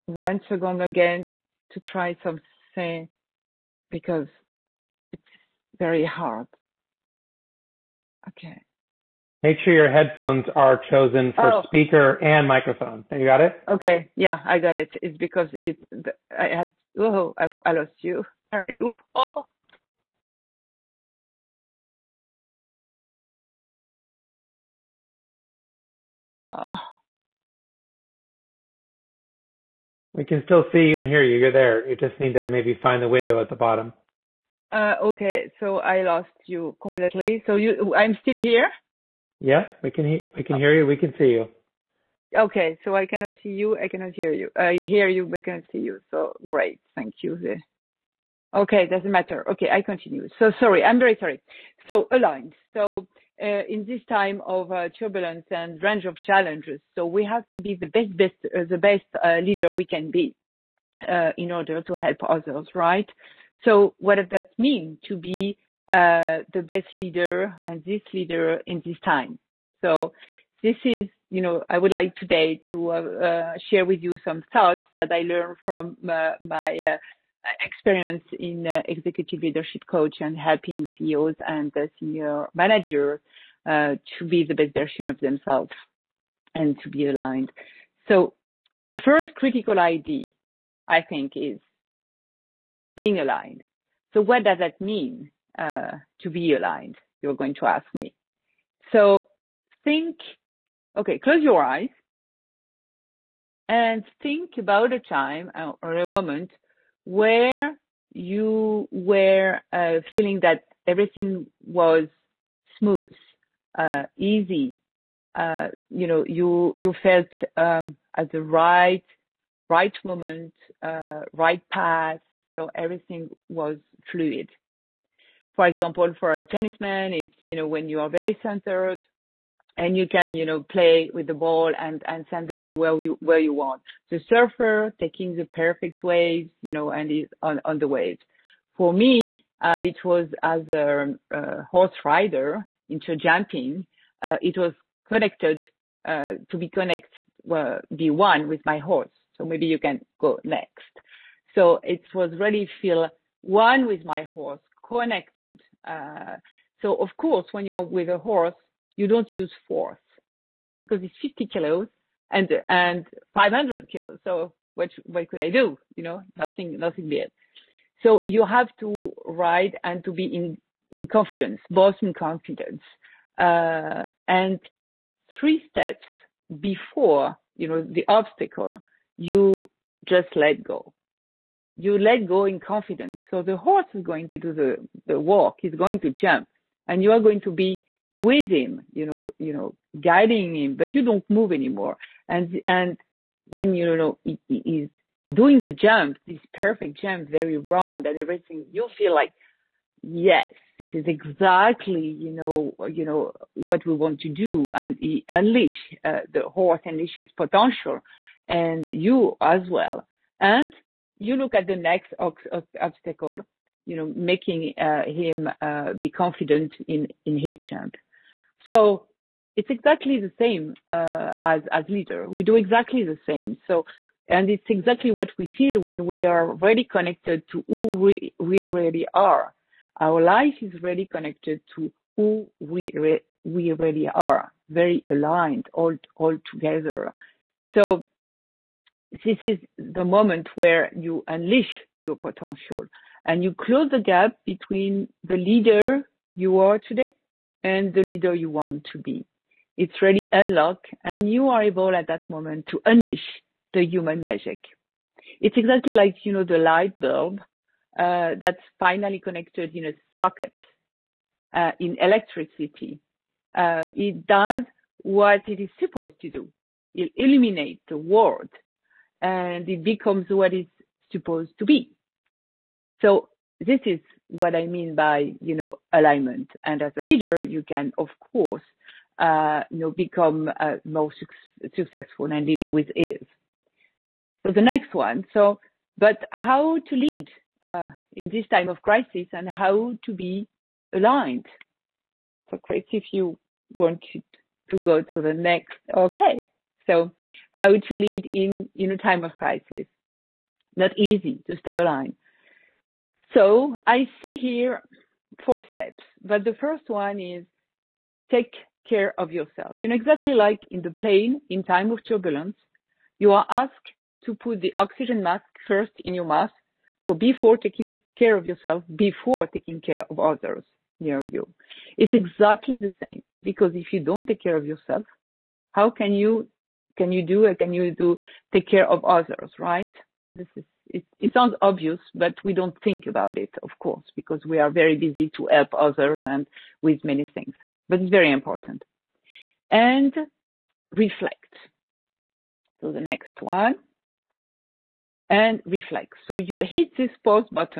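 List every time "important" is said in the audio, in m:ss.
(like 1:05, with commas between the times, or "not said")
5:38.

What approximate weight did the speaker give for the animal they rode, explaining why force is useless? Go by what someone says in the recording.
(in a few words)
500 kilos.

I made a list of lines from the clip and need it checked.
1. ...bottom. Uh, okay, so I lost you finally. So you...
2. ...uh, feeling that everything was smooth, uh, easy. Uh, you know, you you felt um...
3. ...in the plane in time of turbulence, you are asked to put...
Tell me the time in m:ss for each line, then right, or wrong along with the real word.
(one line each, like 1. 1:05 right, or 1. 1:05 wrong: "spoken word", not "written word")
1. 0:33 wrong: "completely", not "finally"
2. 1:49 right
3. 5:10 right.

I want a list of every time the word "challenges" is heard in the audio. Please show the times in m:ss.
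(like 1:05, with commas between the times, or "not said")
0:56.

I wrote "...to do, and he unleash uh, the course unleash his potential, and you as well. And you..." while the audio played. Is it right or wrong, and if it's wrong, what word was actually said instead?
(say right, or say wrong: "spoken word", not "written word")
wrong: "horse", not "course".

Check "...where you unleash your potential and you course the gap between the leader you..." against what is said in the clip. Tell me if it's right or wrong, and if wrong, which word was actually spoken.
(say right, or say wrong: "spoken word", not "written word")
wrong: "close", not "course".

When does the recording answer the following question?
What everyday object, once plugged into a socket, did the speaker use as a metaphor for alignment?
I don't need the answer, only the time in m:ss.
4:16.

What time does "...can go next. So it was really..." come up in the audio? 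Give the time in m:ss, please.
2:29.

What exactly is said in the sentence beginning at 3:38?
So it's exactly the same uh, as, as leader.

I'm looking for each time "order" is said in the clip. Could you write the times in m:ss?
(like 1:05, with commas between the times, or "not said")
1:01.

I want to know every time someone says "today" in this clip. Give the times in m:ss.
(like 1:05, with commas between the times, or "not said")
1:12, 4:06.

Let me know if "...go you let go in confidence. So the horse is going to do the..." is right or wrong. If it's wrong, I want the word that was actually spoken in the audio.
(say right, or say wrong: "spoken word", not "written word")
right.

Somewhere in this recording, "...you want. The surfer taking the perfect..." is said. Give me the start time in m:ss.
2:13.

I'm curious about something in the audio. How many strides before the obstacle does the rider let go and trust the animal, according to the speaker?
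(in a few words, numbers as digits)
3 steps.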